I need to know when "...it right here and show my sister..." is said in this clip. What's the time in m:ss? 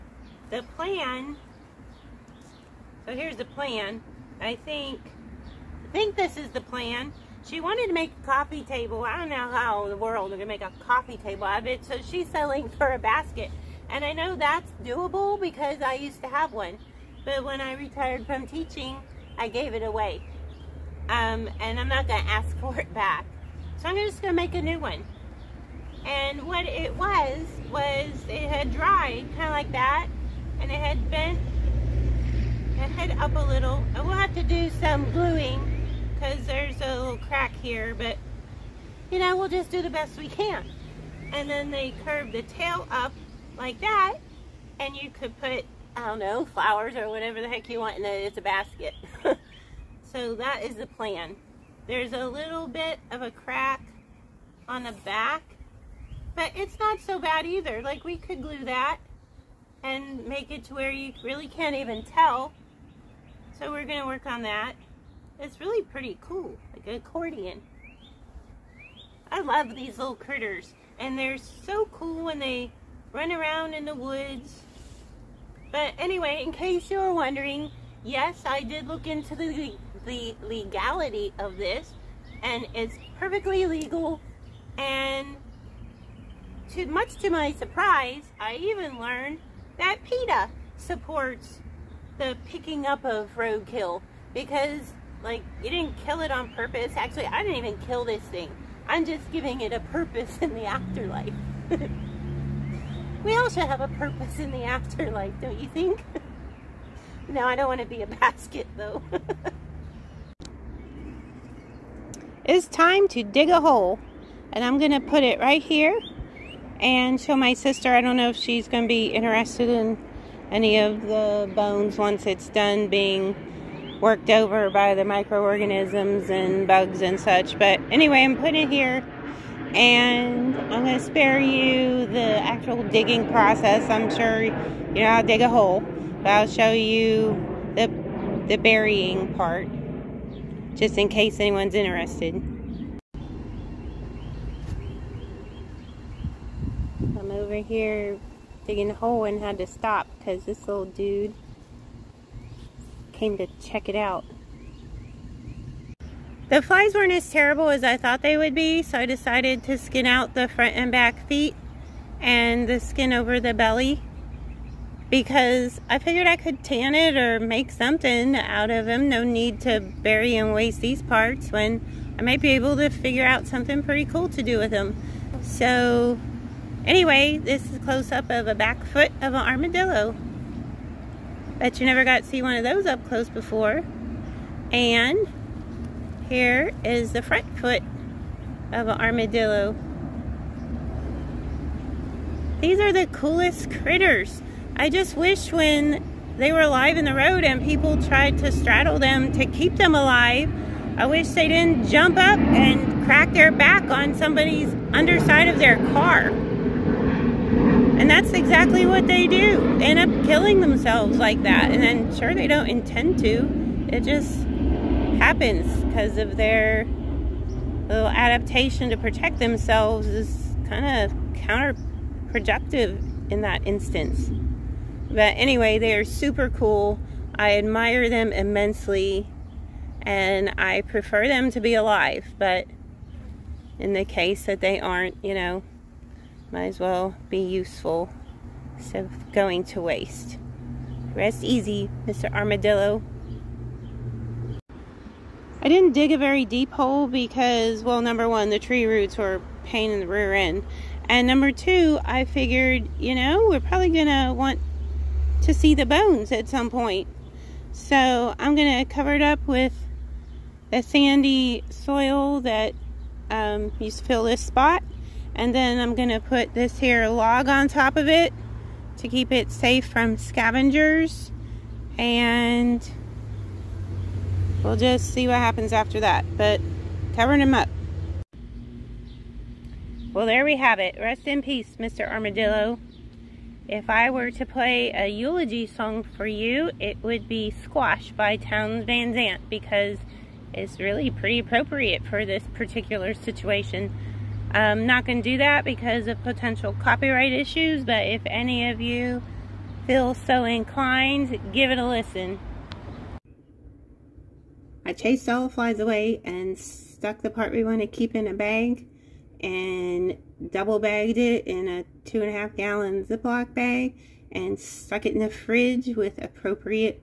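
1:55.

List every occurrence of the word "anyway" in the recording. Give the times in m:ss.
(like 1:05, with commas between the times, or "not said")
1:15, 2:07, 2:56, 3:45.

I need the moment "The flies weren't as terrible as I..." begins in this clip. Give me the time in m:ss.
2:36.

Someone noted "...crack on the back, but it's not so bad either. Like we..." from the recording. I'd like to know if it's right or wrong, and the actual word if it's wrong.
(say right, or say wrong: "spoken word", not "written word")
right.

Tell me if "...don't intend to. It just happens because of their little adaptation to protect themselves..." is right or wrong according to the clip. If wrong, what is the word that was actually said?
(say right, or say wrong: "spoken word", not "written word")
right.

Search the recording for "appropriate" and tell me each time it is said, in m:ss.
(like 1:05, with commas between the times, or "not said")
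4:51, 5:16.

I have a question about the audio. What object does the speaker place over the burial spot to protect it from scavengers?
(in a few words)
log.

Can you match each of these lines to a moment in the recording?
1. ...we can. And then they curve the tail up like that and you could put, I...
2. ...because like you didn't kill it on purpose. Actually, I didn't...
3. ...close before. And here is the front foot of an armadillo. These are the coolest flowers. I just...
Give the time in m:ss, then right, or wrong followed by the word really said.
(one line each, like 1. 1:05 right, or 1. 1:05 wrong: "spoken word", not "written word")
1. 0:40 right
2. 1:34 right
3. 3:03 wrong: "critters", not "flowers".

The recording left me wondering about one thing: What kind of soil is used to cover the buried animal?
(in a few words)
sandy soil.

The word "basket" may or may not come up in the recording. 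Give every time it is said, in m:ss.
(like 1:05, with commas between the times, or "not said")
0:12, 0:48, 1:48.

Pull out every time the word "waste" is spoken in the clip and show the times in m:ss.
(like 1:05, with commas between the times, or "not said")
2:50, 3:59.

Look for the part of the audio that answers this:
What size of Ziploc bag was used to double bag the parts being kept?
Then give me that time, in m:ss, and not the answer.
5:12.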